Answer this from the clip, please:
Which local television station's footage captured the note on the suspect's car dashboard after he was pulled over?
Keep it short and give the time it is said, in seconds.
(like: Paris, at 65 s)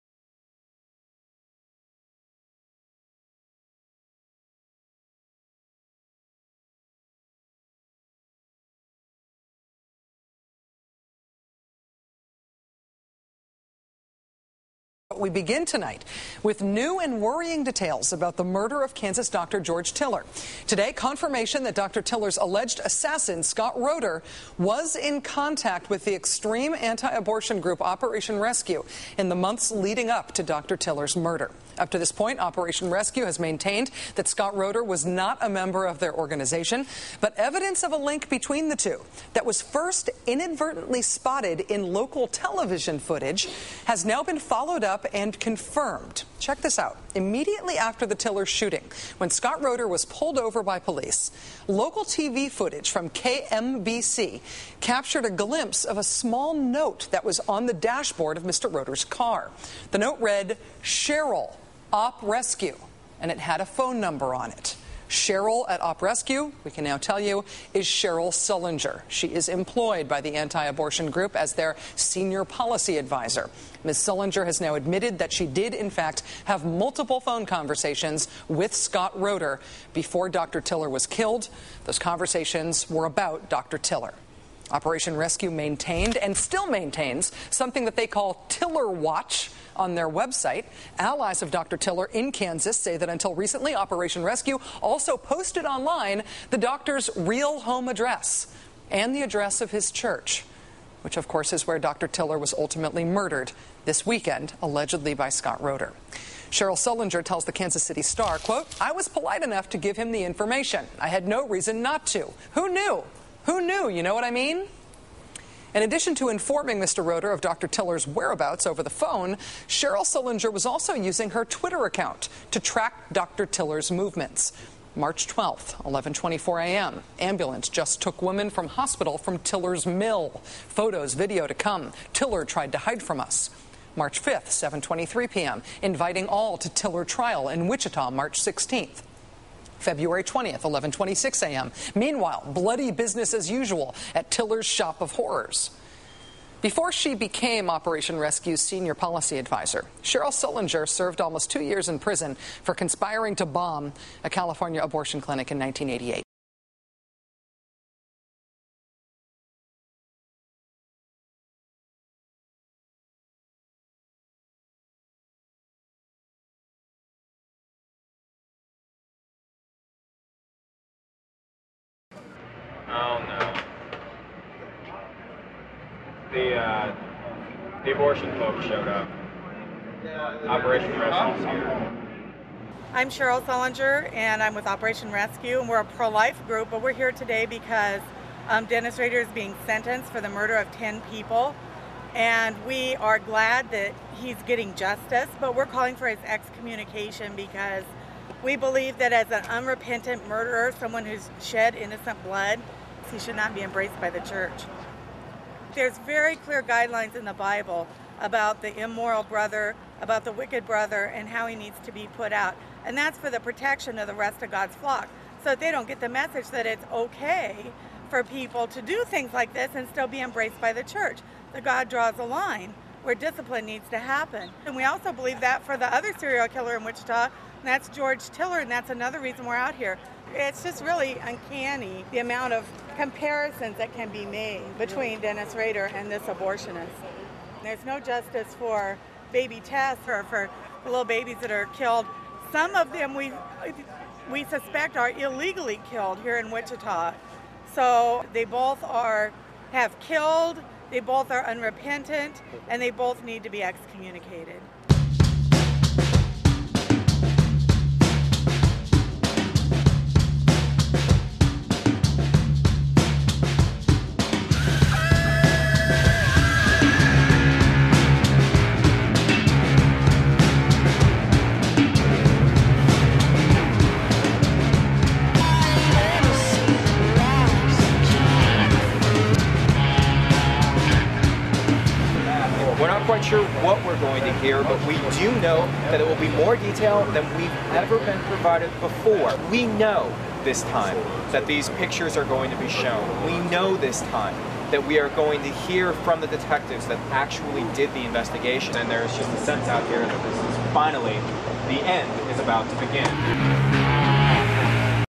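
KMBC, at 53 s.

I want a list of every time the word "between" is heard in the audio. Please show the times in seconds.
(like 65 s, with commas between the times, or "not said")
38 s, 234 s.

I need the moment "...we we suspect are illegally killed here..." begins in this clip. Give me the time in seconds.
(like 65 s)
243 s.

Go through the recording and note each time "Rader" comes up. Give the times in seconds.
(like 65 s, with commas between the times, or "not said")
188 s, 235 s.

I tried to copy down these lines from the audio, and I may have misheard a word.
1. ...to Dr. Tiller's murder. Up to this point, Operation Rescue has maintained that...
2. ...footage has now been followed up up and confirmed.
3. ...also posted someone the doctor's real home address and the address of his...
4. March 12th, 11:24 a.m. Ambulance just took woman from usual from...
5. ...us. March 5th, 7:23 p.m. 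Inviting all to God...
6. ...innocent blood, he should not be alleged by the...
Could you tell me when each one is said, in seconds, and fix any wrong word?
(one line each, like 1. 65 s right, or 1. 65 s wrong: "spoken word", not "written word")
1. 30 s right
2. 42 s right
3. 94 s wrong: "online", not "someone"
4. 124 s wrong: "hospital", not "usual"
5. 133 s wrong: "Tiller", not "God"
6. 201 s wrong: "embraced", not "alleged".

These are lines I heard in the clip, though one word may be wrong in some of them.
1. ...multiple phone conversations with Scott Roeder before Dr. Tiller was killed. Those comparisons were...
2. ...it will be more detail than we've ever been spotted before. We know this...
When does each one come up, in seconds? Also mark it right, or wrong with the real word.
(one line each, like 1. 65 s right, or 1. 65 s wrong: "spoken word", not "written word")
1. 76 s wrong: "conversations", not "comparisons"
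2. 286 s wrong: "provided", not "spotted".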